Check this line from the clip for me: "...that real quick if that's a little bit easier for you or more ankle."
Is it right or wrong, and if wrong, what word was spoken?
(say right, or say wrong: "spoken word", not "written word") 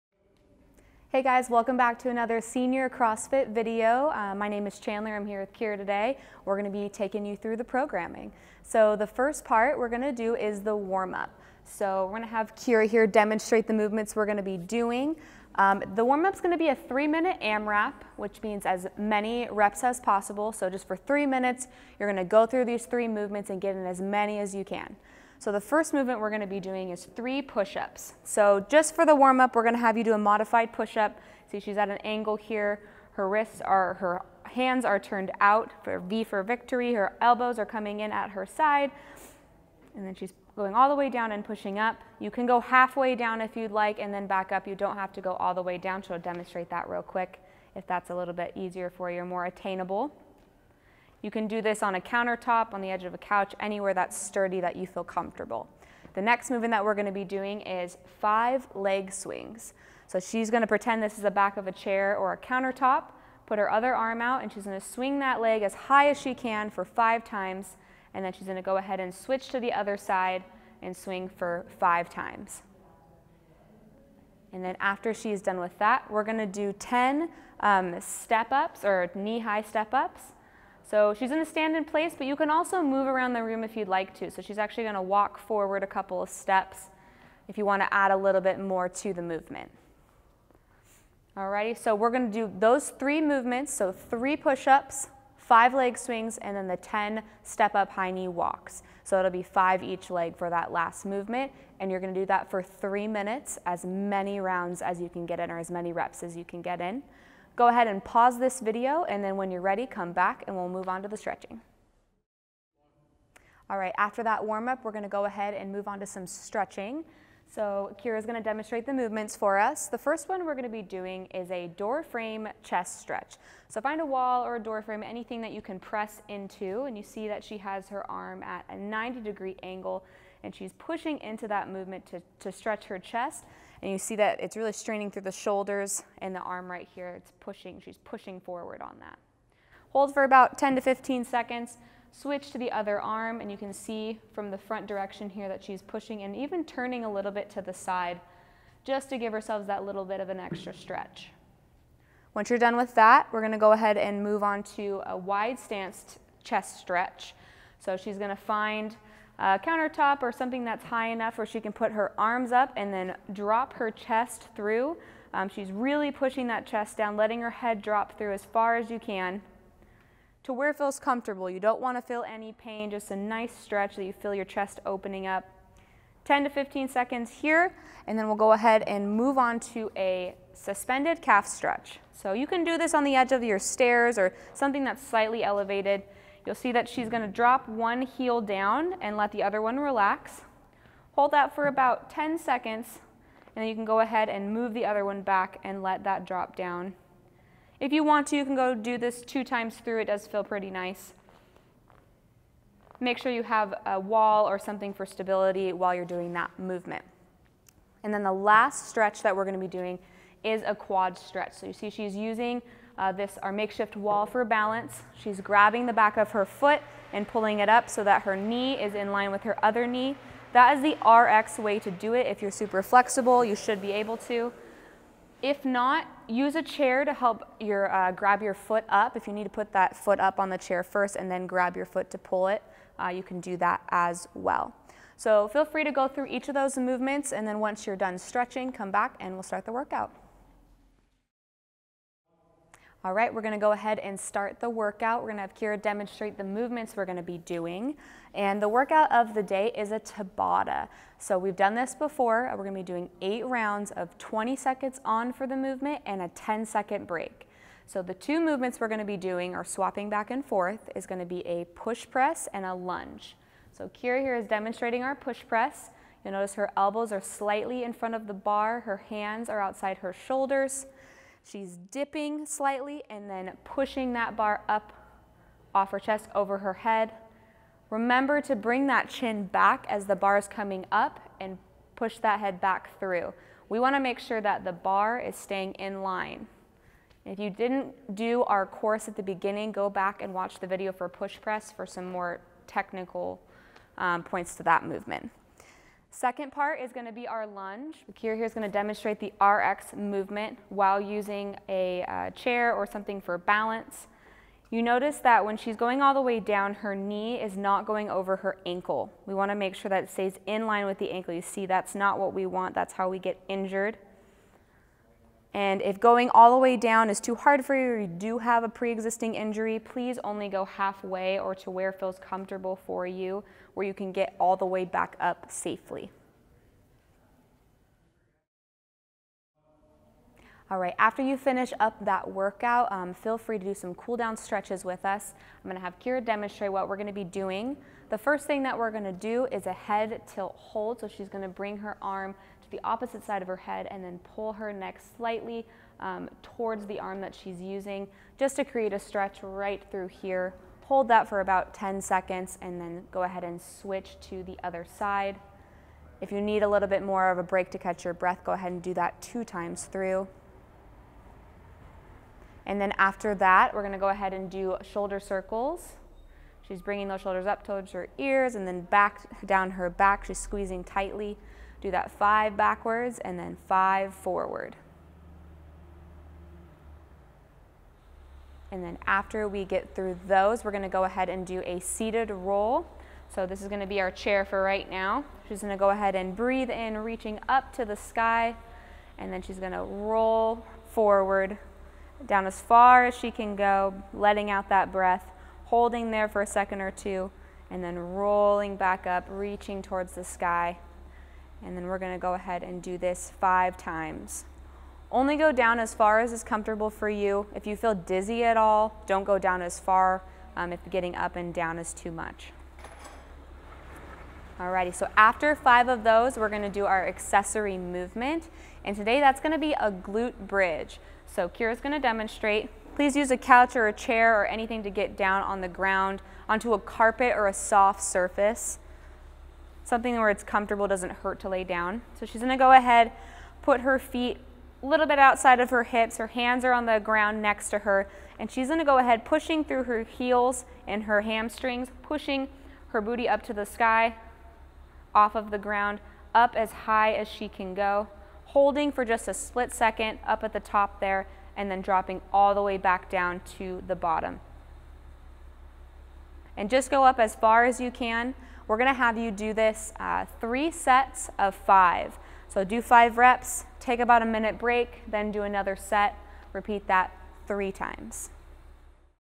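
wrong: "attainable", not "ankle".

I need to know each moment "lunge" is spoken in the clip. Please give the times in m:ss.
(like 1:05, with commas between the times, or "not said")
4:22, 4:57.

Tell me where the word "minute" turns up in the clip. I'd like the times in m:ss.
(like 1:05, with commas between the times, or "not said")
0:17, 0:21, 1:43, 7:44.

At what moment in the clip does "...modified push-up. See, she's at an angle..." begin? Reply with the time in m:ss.
0:30.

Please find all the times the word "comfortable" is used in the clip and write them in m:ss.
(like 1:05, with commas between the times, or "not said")
0:55, 2:50, 5:22, 6:46, 7:10.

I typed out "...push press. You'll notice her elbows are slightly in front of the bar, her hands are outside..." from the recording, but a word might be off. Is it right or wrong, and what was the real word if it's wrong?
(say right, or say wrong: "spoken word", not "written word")
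right.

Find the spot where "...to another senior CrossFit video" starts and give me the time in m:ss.
0:02.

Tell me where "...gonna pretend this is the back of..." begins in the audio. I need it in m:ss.
1:00.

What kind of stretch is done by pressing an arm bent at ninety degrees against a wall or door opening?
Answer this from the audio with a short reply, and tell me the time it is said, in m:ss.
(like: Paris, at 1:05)
Door frame chest stretch, at 2:01.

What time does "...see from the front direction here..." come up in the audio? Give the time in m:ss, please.
2:23.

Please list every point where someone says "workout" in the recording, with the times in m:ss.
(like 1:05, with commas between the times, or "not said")
3:59, 4:04, 4:08, 5:32.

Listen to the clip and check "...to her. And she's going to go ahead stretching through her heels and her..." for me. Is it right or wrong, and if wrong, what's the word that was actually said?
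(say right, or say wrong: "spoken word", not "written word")
wrong: "pushing", not "stretching".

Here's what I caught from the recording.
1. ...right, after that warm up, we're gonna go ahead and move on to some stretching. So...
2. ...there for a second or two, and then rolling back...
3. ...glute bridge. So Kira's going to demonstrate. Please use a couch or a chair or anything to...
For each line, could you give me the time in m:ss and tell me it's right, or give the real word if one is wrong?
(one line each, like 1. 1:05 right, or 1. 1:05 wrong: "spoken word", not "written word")
1. 1:53 right
2. 6:36 right
3. 6:59 right.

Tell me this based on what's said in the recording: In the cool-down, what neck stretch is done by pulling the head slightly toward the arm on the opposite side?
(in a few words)
Head tilt hold.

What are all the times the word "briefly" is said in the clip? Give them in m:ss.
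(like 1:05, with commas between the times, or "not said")
not said.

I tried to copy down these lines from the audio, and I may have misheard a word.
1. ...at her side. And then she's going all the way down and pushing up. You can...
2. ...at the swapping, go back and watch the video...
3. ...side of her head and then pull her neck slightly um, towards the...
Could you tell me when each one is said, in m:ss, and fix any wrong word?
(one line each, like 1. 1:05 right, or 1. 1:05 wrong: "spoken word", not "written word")
1. 0:38 right
2. 4:49 wrong: "beginning", not "swapping"
3. 5:43 right.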